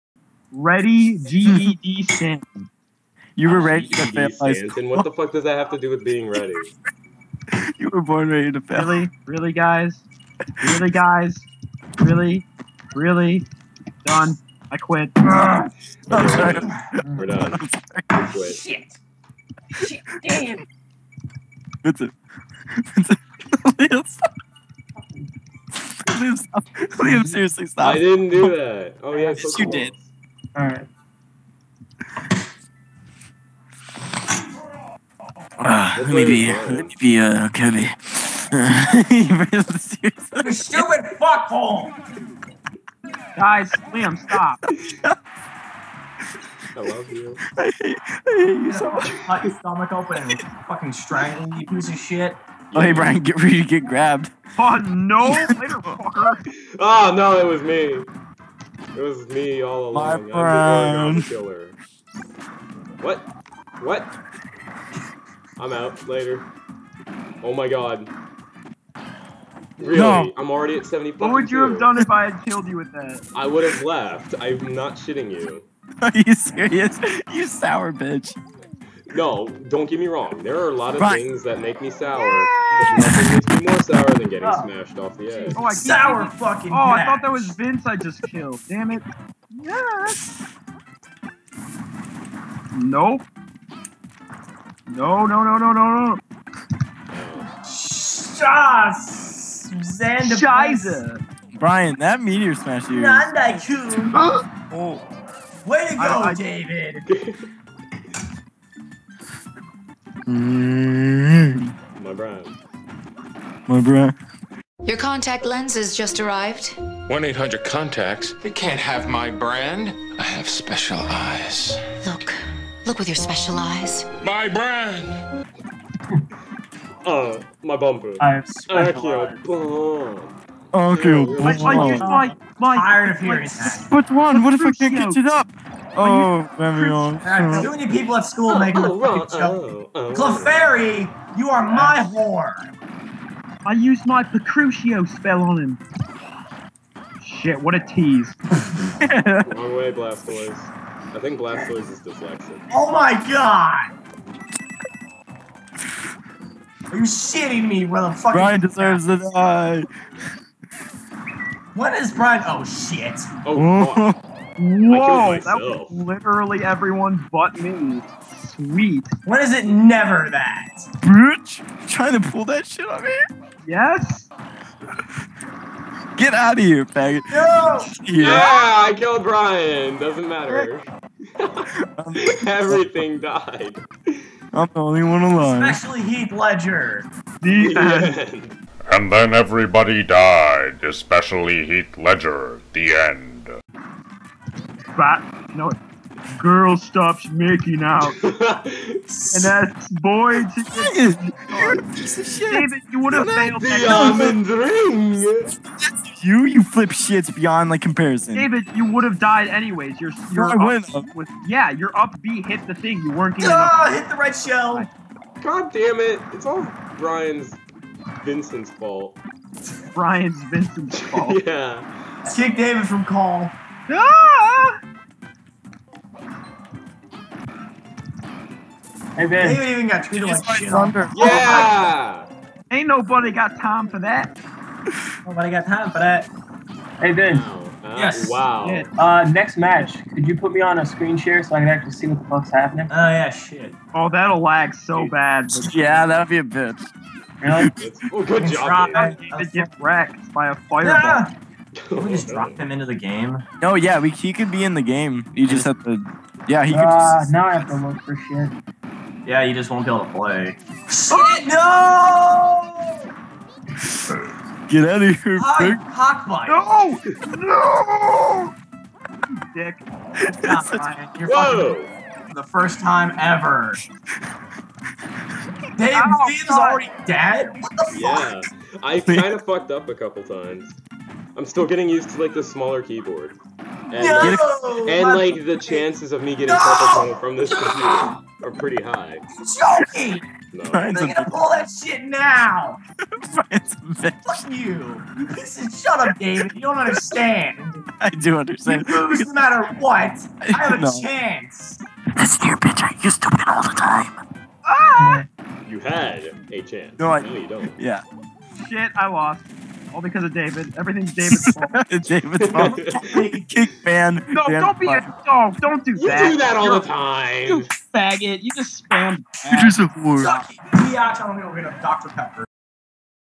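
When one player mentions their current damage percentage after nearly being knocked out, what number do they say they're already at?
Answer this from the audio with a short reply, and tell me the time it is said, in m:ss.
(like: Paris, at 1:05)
70, at 1:10.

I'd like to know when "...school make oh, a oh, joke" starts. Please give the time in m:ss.
2:18.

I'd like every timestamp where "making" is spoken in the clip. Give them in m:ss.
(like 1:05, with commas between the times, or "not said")
3:17.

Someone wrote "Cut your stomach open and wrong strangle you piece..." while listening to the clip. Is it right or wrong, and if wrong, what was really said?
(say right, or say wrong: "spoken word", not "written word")
wrong: "fucking", not "wrong".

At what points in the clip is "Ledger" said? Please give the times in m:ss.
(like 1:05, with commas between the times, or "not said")
3:06, 3:11.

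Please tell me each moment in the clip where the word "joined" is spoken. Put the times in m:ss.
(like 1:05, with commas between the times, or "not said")
not said.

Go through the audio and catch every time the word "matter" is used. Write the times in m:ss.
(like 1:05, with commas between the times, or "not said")
3:00, 4:59.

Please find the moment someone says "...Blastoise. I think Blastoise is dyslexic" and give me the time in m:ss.
2:29.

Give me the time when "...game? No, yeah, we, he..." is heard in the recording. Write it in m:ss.
4:12.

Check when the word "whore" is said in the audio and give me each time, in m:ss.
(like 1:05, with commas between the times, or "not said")
2:22, 5:19.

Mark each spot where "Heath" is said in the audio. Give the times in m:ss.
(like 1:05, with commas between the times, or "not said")
3:06, 3:11.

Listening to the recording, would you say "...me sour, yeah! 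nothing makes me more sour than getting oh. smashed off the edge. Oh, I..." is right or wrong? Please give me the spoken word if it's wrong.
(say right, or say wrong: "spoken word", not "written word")
right.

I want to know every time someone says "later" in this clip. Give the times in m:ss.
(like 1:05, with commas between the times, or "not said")
0:55, 1:06.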